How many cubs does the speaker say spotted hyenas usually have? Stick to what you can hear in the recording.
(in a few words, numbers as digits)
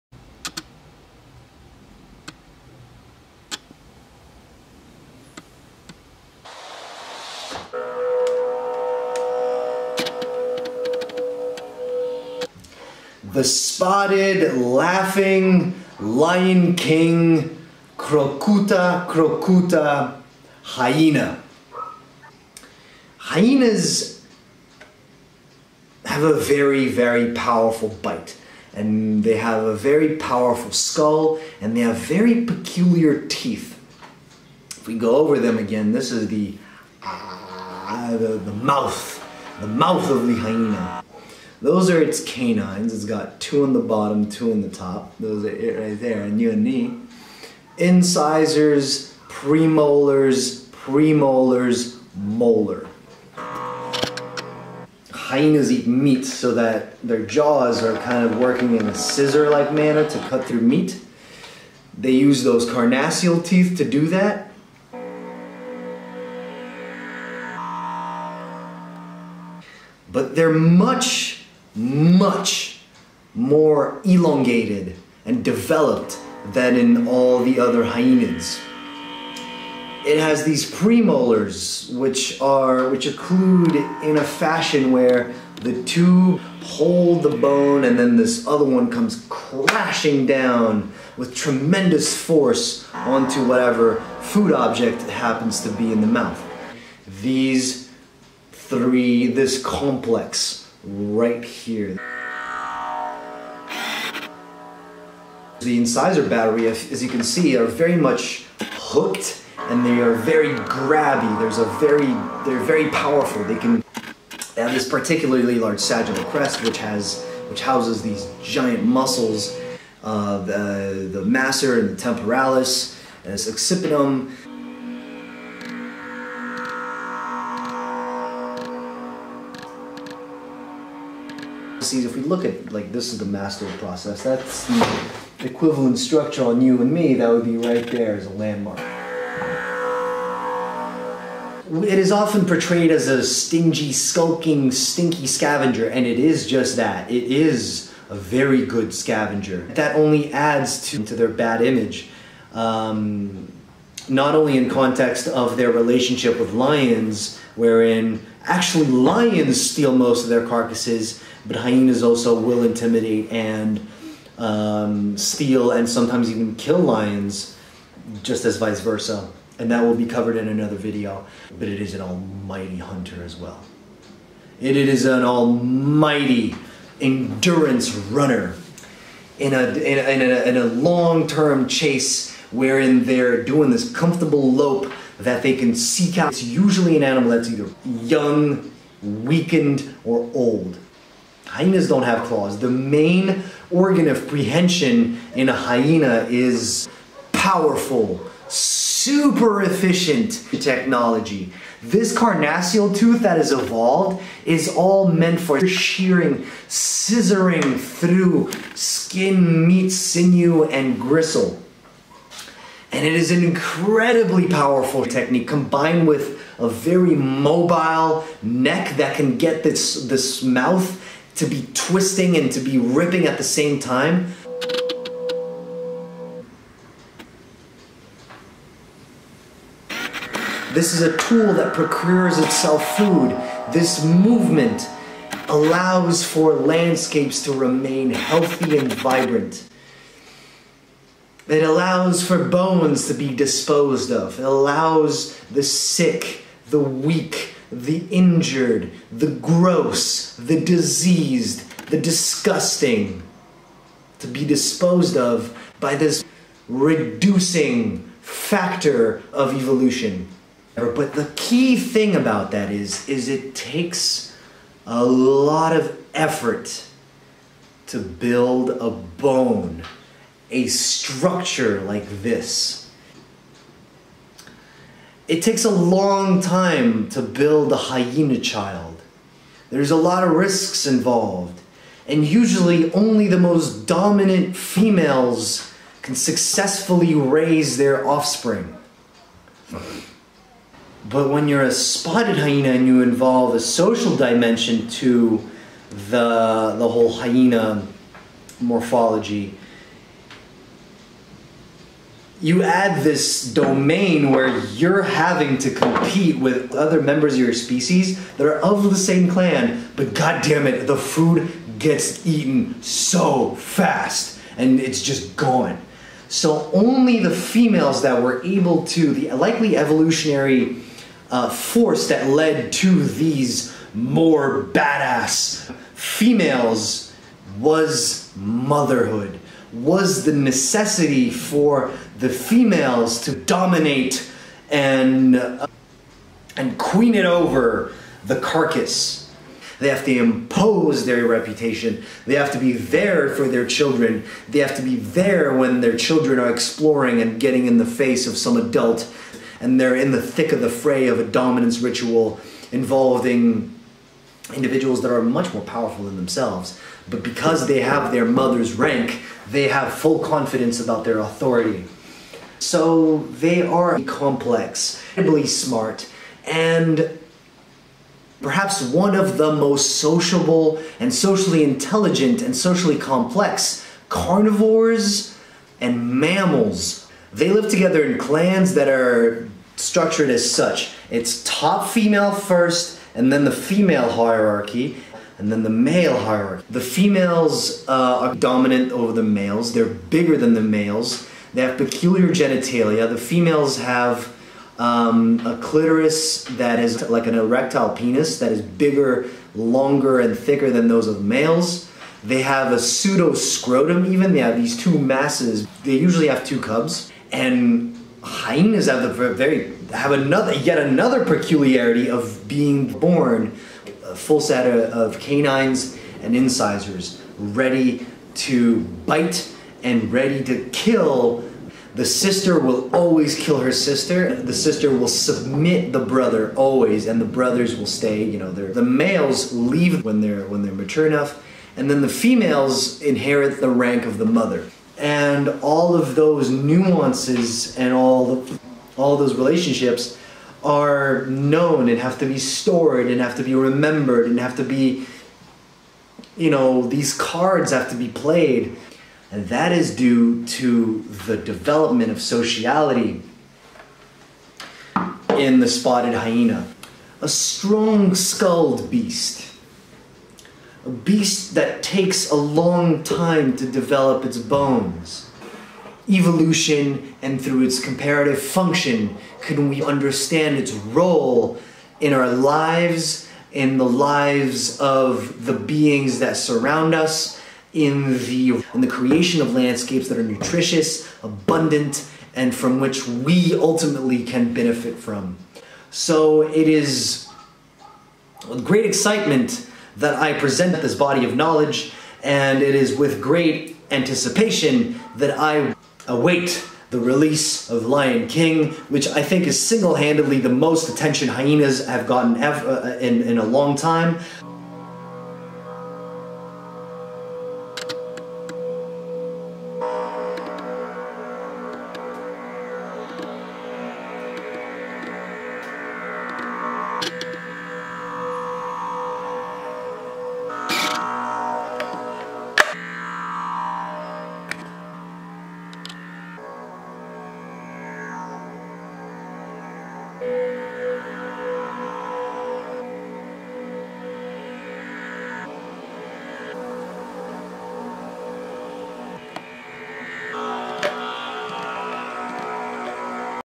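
2.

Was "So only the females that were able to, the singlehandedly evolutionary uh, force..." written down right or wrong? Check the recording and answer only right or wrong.
wrong.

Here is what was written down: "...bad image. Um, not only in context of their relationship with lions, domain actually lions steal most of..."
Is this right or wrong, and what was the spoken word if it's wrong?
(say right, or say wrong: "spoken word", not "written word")
wrong: "wherein", not "domain".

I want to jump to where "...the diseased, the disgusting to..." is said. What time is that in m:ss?
4:10.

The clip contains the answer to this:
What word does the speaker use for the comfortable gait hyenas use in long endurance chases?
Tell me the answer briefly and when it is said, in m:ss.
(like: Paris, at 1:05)
lope, at 3:04.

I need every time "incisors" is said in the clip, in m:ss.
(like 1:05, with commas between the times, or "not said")
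0:47, 1:45, 6:56.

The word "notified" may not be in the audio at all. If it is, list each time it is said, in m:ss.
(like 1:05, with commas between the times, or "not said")
not said.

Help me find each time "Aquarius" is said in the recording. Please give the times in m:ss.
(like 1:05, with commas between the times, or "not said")
not said.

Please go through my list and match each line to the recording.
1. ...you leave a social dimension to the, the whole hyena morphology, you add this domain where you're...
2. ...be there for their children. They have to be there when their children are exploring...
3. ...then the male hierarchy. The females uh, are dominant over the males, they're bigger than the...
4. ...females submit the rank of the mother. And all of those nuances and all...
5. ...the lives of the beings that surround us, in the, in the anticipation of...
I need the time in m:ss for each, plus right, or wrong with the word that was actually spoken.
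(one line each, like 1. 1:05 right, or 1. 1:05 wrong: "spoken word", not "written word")
1. 4:52 wrong: "involve", not "leave"
2. 5:42 right
3. 6:25 right
4. 7:12 wrong: "inherit", not "submit"
5. 7:53 wrong: "creation", not "anticipation".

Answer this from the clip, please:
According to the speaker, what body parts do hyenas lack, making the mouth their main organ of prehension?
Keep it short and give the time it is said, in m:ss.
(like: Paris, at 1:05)
claws, at 3:12.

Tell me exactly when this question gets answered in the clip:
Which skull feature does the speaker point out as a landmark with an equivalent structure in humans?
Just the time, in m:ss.
2:13.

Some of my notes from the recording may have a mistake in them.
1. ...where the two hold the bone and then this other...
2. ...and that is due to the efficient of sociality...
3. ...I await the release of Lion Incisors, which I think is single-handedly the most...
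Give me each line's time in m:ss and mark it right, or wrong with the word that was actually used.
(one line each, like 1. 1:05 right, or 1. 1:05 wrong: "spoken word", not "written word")
1. 1:24 right
2. 7:29 wrong: "development", not "efficient"
3. 8:15 wrong: "King", not "Incisors".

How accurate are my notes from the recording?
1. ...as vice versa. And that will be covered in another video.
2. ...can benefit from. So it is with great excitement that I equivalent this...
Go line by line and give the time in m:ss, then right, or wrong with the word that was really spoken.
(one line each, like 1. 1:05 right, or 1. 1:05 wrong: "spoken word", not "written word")
1. 2:48 right
2. 8:04 wrong: "present", not "equivalent".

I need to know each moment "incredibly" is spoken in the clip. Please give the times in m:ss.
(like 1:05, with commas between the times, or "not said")
3:33, 6:05.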